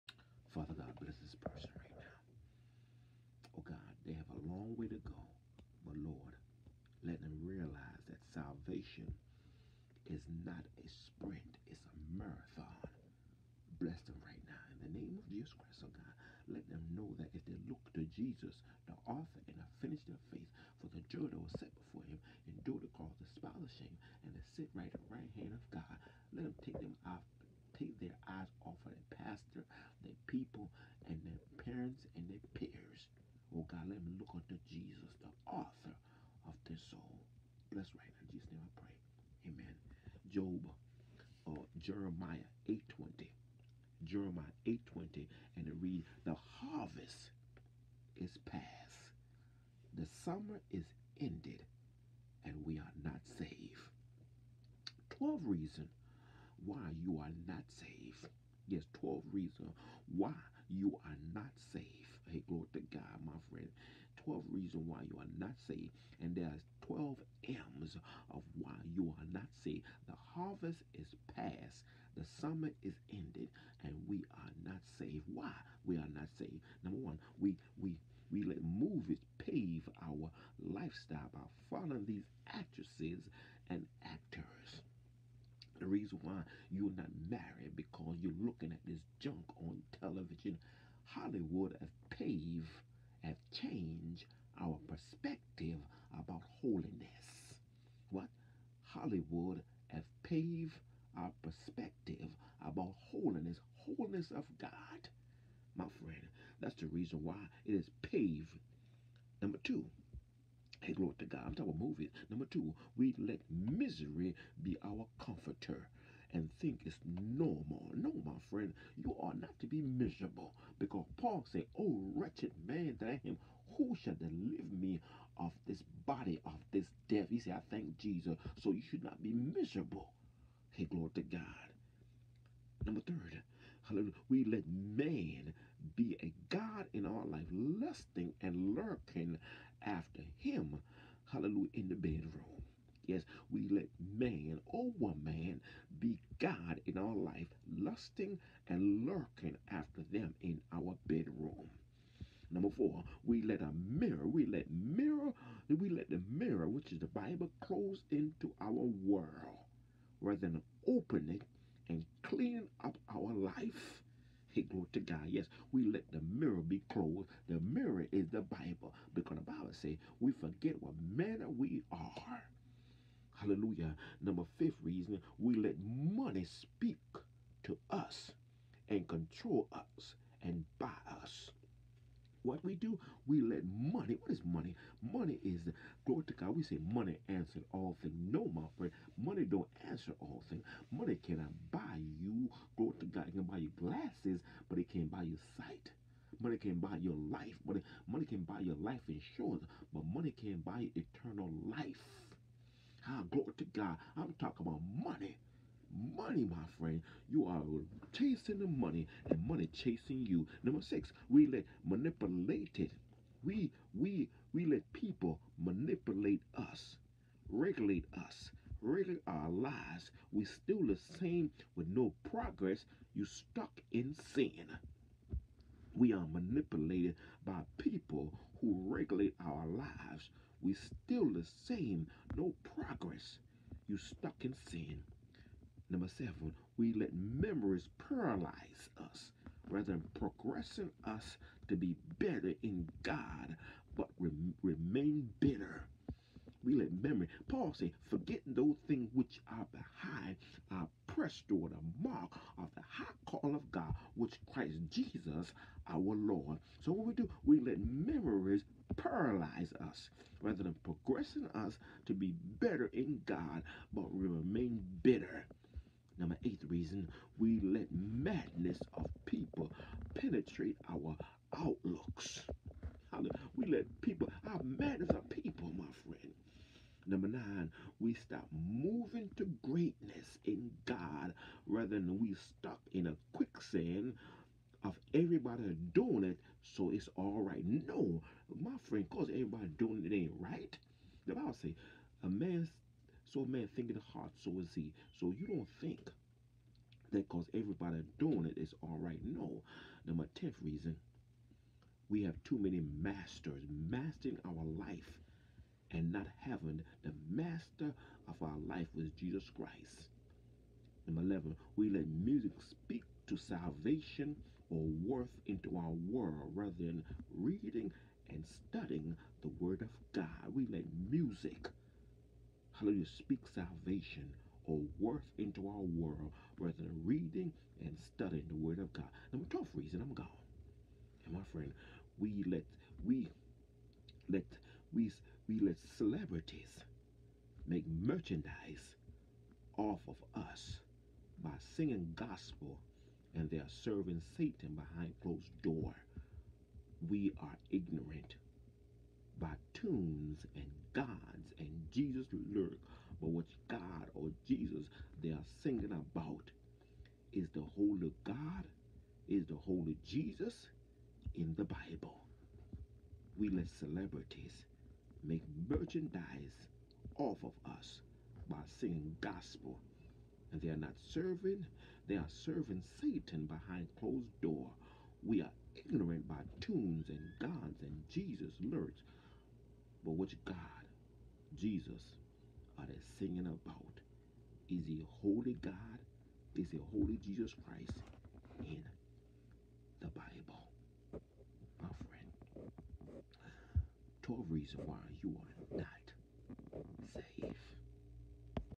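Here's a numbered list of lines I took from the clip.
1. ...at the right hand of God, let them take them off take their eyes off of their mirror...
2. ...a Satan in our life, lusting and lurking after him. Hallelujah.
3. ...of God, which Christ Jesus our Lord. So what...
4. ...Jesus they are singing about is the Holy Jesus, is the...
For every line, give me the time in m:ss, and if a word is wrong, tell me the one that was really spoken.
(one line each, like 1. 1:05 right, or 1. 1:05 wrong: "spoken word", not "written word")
1. 0:24 wrong: "pastor", not "mirror"
2. 2:16 wrong: "God", not "Satan"
3. 4:13 right
4. 5:54 wrong: "God", not "Jesus".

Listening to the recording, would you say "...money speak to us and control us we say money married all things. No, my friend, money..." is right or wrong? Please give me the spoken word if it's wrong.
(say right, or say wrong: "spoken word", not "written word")
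wrong: "answered", not "married".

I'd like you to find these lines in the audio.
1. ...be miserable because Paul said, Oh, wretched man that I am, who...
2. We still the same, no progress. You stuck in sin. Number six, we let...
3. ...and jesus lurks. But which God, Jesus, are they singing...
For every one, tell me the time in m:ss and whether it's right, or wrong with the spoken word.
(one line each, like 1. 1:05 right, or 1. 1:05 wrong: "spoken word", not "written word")
1. 1:59 right
2. 3:50 wrong: "seven", not "six"
3. 6:17 right.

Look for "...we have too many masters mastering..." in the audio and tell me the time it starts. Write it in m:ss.
5:02.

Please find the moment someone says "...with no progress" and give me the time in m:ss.
3:41.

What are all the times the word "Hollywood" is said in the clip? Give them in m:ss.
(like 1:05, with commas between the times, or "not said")
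1:31, 1:38.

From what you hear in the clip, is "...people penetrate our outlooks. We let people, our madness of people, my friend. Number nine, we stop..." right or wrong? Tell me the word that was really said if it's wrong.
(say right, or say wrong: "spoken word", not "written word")
right.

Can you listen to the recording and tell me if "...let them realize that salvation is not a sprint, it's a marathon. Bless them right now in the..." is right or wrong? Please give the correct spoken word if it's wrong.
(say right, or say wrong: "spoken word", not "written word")
right.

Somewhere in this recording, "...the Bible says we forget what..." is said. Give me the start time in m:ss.
2:49.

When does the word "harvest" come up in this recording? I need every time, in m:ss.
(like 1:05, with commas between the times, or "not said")
0:46, 1:10.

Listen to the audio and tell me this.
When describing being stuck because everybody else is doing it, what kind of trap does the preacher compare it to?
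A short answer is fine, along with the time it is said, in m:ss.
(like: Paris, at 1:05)
Quicksand, at 4:43.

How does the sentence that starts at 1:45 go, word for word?
My friend, that's the reason why it is paved.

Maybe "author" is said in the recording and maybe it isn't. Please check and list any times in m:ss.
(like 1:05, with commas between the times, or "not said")
0:19, 0:35.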